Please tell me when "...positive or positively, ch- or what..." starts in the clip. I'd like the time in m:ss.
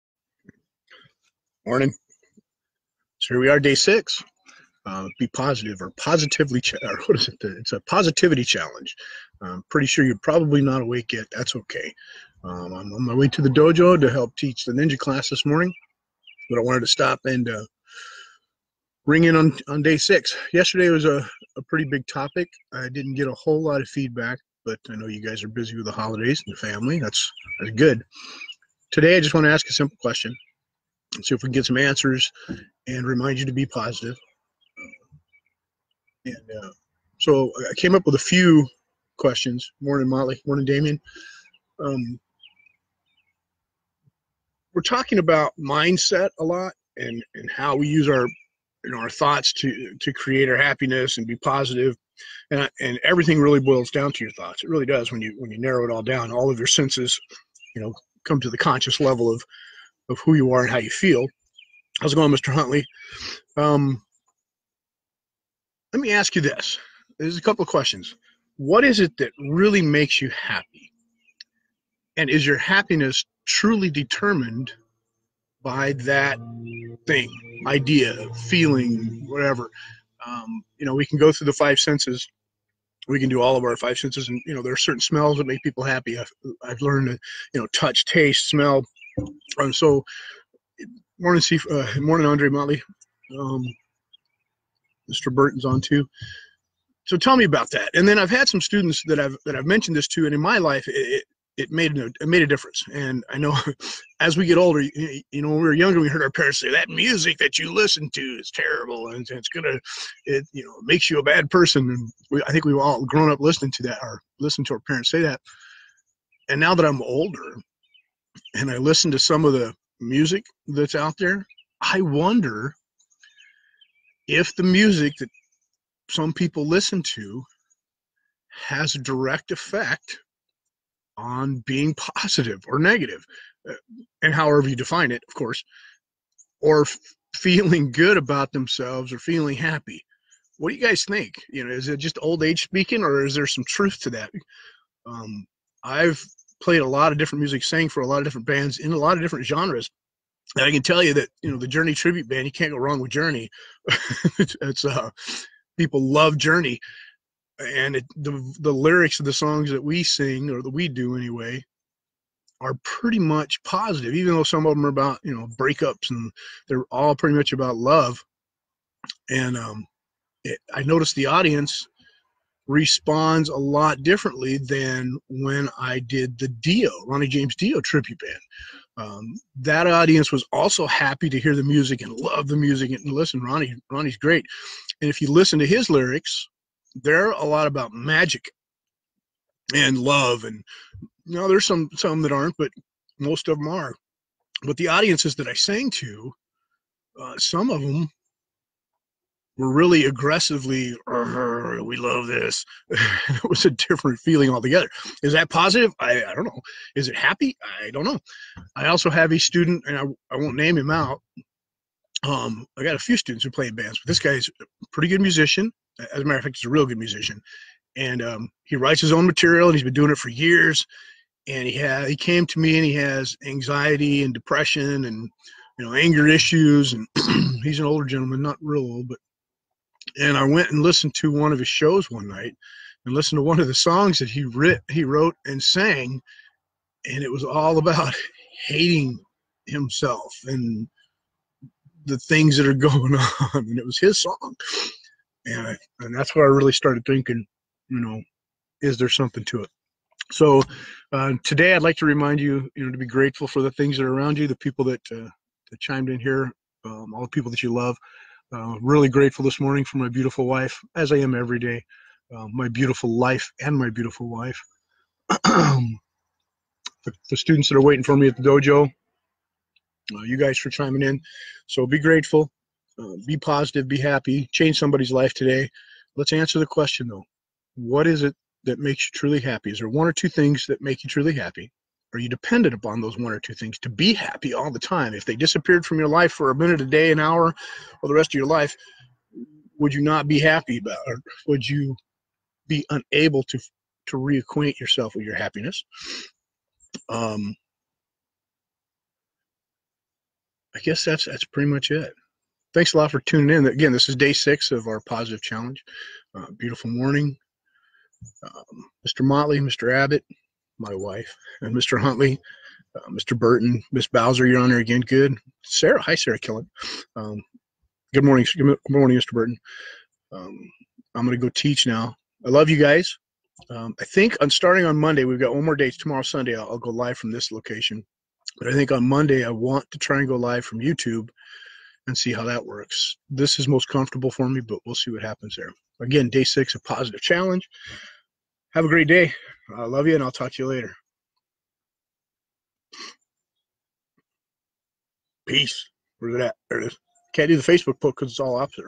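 0:05.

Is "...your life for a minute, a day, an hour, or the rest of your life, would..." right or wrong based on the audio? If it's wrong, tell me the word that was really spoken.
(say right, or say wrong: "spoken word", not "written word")
right.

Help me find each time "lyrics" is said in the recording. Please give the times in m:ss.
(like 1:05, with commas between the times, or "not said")
2:38, 3:05.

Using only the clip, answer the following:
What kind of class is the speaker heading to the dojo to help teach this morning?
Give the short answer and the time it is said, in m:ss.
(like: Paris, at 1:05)
ninja class, at 0:14.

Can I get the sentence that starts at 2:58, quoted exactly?
Um, that audience was also happy to hear the music and love the music and listen.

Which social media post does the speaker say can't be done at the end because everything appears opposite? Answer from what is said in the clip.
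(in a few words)
Facebook post.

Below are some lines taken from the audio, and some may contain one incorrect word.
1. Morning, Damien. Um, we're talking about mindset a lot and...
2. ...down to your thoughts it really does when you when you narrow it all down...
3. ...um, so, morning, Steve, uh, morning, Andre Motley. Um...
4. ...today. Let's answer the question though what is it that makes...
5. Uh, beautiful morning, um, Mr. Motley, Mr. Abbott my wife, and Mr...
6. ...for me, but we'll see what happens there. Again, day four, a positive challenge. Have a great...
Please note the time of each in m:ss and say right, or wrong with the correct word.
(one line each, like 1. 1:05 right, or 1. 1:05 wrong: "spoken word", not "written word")
1. 0:40 right
2. 0:53 right
3. 1:29 right
4. 4:35 right
5. 5:06 right
6. 5:34 wrong: "six", not "four".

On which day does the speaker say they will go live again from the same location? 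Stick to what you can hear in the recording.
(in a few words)
Sunday.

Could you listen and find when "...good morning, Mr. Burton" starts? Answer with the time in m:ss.
5:18.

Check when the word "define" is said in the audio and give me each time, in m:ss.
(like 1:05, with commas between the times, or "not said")
2:14.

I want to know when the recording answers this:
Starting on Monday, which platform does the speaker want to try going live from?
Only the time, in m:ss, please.
5:30.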